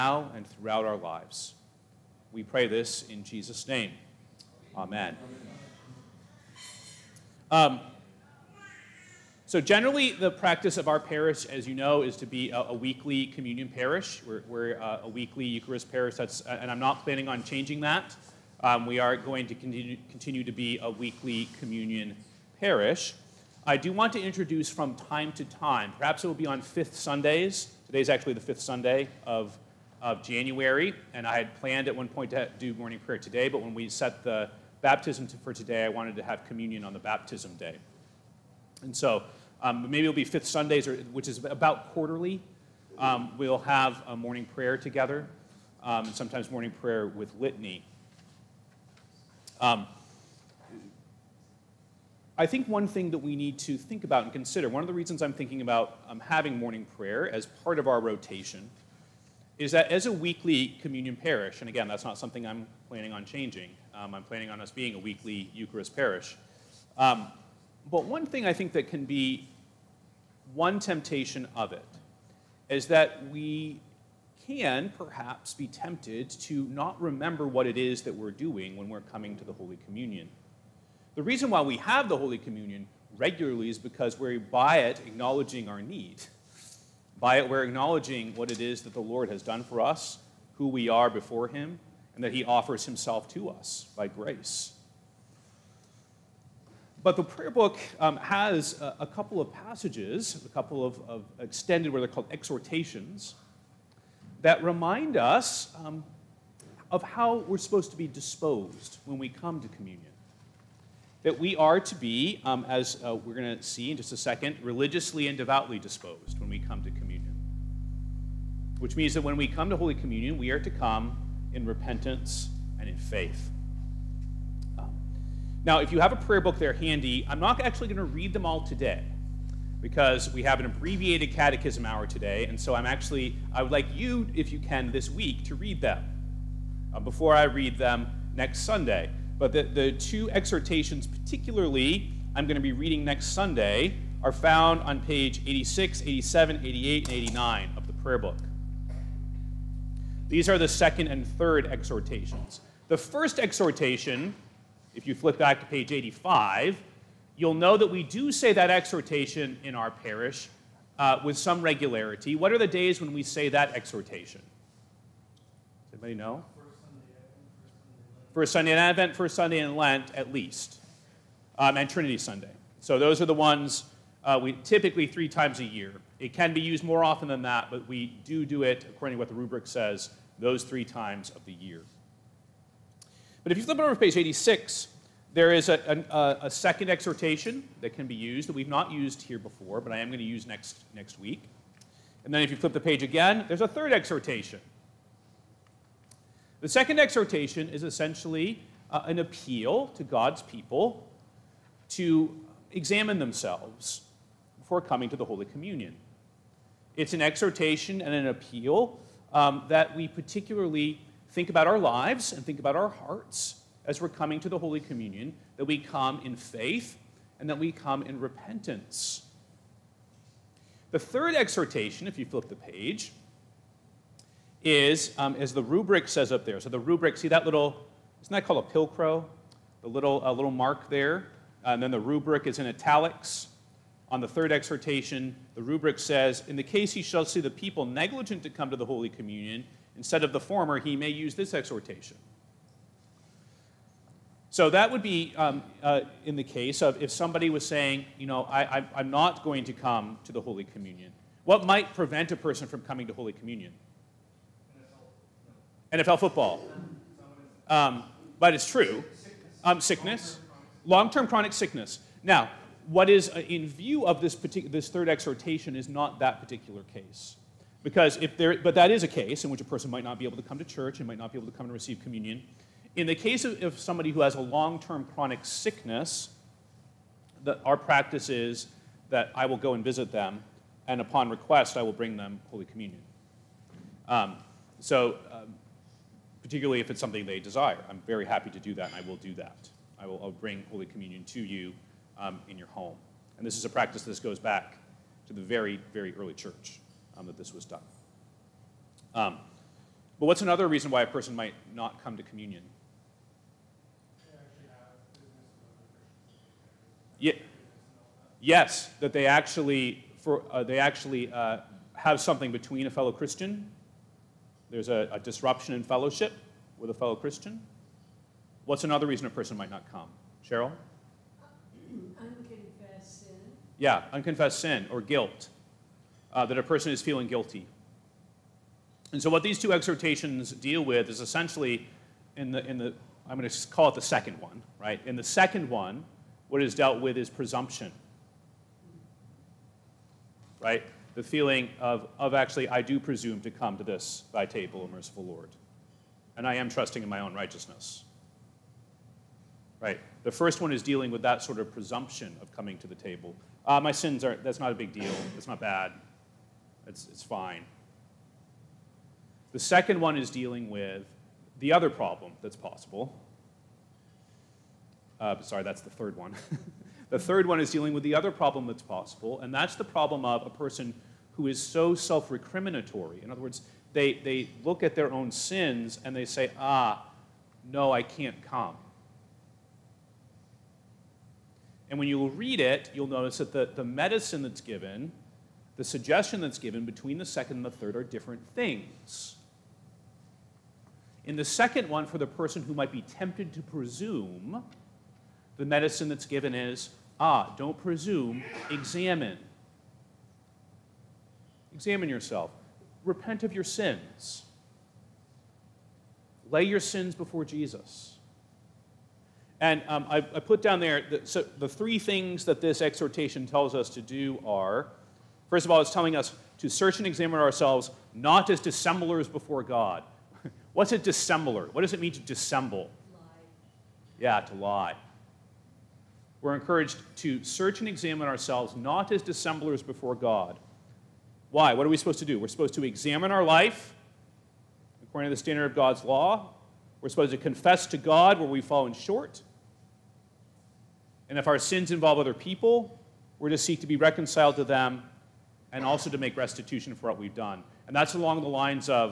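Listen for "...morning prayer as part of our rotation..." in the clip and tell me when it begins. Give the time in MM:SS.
00:56.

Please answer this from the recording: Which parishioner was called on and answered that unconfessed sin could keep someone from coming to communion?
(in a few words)
Cheryl.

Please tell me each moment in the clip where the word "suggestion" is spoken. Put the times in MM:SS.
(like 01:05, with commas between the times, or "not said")
06:25.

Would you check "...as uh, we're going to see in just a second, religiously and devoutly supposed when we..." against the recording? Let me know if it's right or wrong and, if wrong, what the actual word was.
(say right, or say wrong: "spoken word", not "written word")
wrong: "disposed", not "supposed".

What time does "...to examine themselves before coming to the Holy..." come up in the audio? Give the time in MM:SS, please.
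03:21.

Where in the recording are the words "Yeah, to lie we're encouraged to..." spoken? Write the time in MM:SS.
07:04.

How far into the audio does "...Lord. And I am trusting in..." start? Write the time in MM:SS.
05:45.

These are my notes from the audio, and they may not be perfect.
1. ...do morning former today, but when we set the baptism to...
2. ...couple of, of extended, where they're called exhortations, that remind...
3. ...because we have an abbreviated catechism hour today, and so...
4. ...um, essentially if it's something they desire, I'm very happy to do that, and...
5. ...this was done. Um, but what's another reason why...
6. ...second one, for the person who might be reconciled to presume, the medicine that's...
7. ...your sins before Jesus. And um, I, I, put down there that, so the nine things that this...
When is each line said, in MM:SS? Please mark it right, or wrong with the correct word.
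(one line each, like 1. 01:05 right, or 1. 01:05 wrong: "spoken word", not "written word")
1. 00:32 wrong: "prayer", not "former"
2. 01:40 right
3. 02:09 right
4. 04:45 wrong: "particularly", not "essentially"
5. 04:57 right
6. 06:31 wrong: "tempted", not "reconciled"
7. 06:46 wrong: "three", not "nine".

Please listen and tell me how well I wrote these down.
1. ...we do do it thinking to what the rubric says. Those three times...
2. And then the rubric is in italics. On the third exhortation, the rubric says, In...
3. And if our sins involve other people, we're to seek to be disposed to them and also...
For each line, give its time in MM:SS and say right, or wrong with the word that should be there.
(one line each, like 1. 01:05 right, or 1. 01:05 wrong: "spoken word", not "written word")
1. 02:57 wrong: "according", not "thinking"
2. 03:51 right
3. 07:21 wrong: "reconciled", not "disposed".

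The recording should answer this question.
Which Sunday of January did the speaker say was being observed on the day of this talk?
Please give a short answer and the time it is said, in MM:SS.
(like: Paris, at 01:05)
Fifth Sunday, at 00:28.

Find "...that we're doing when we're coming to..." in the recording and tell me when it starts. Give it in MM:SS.
01:18.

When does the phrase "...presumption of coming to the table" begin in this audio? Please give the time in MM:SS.
05:51.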